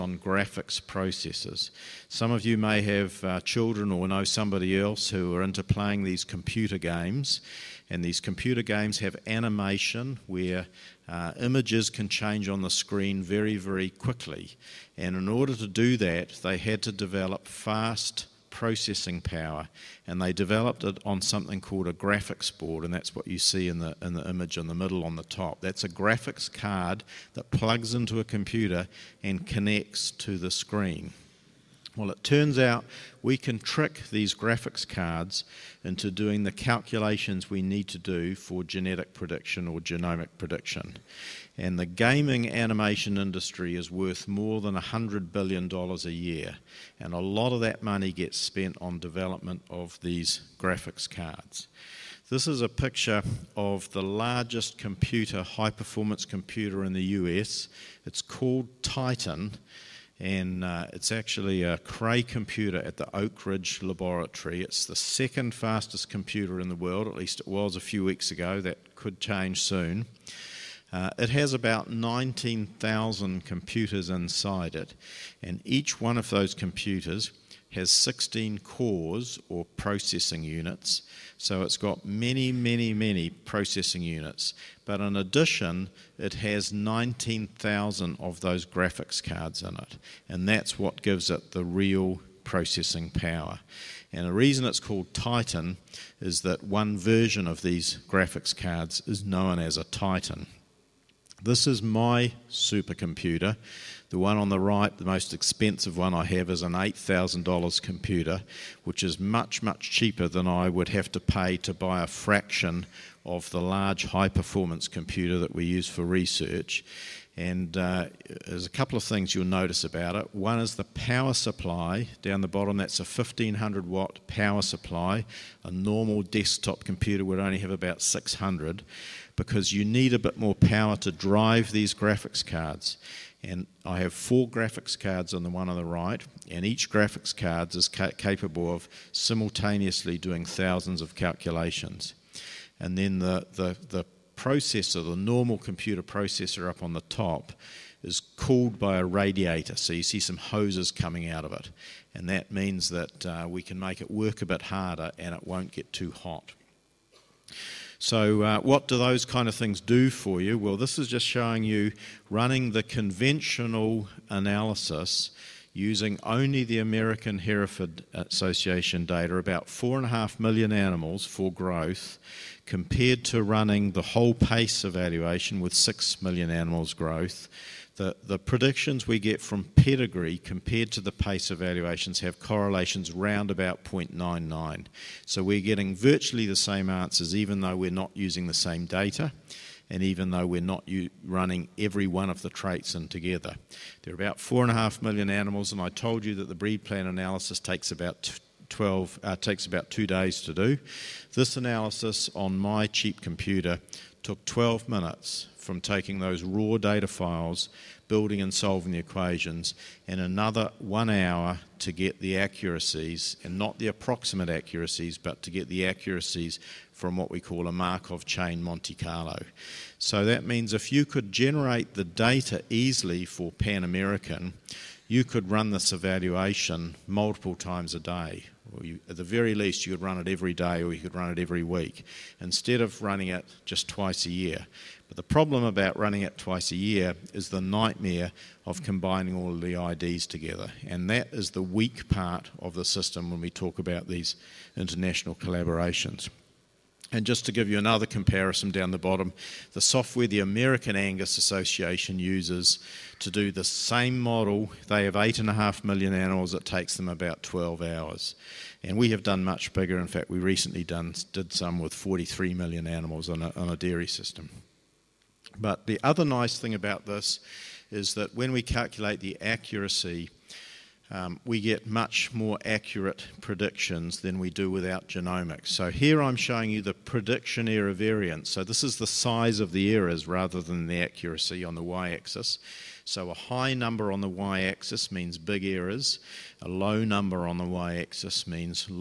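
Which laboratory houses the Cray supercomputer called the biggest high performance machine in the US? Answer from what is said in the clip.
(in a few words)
Oak Ridge Laboratory.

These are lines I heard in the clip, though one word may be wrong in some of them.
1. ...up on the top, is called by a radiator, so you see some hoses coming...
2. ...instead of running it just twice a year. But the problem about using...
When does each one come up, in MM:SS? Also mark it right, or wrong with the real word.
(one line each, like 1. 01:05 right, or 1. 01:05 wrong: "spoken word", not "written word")
1. 02:26 wrong: "cooled", not "called"
2. 03:52 wrong: "running", not "using".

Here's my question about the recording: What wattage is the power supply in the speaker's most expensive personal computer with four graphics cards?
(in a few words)
1500 watt.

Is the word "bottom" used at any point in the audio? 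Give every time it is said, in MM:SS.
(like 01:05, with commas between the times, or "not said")
02:02, 04:08.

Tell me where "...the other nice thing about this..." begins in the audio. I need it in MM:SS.
04:25.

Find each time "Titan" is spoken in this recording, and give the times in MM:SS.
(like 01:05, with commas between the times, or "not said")
00:58, 01:35, 01:39.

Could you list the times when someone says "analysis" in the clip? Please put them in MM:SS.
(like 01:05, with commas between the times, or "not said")
02:44, 03:17, 03:21.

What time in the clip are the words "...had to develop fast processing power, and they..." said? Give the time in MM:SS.
00:16.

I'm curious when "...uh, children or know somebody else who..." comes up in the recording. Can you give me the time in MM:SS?
00:03.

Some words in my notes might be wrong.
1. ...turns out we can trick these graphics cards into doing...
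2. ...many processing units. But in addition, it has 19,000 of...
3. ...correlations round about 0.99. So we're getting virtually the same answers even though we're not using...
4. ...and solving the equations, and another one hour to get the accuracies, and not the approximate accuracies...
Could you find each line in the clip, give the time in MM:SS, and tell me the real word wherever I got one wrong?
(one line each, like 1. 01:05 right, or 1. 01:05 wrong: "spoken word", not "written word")
1. 00:32 right
2. 01:22 right
3. 03:02 right
4. 03:28 right.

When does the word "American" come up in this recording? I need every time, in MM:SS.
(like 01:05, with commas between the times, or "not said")
02:46, 03:43, 04:10.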